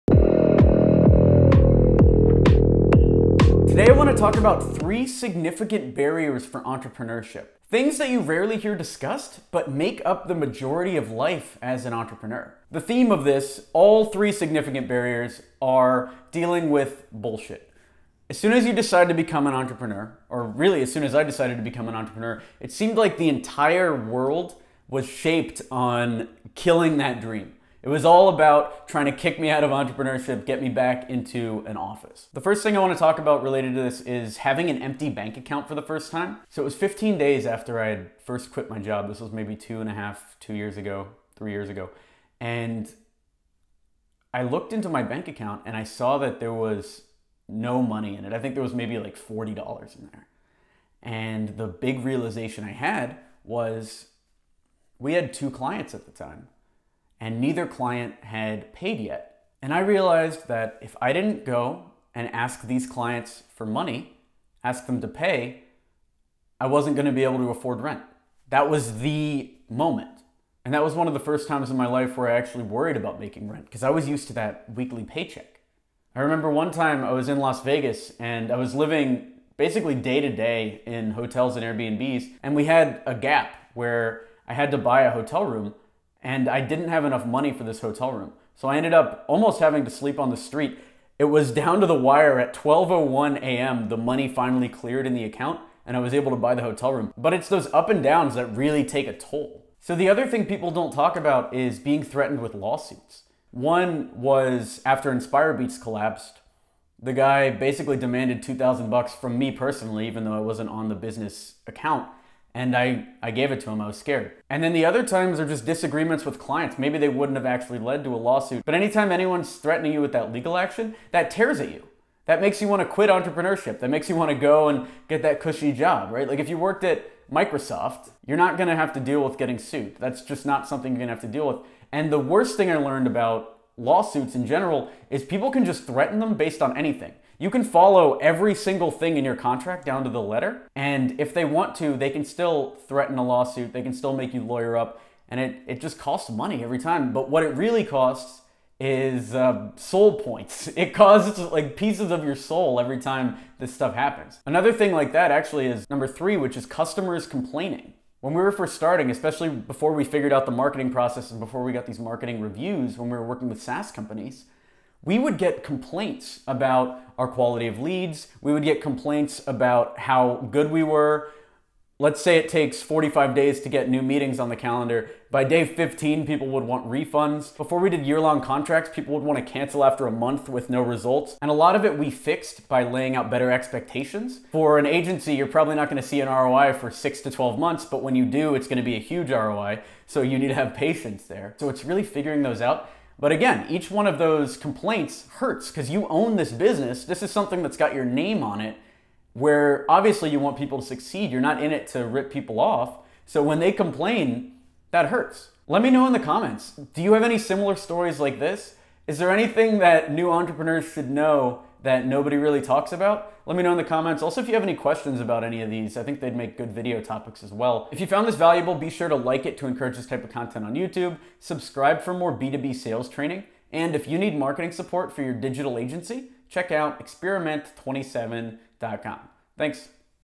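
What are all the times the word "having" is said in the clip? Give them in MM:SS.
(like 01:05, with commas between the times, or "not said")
00:34, 01:29.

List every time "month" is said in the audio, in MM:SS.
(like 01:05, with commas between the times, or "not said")
03:00, 03:07.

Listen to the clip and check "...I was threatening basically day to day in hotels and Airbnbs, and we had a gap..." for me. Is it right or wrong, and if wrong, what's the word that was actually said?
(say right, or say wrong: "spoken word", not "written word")
wrong: "living", not "threatening".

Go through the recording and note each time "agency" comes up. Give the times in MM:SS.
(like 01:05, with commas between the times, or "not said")
03:04, 03:45.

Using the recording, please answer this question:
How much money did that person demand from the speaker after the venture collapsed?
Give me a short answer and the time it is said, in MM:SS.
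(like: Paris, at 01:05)
$2000, at 01:48.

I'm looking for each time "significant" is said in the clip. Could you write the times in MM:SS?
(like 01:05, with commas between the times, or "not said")
00:05, 00:14.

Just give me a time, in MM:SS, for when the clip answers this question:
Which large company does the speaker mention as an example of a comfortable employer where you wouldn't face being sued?
02:07.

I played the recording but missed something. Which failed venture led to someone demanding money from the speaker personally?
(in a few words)
Inspire Beats.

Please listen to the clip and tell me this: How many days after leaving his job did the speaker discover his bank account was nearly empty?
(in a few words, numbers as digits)
15.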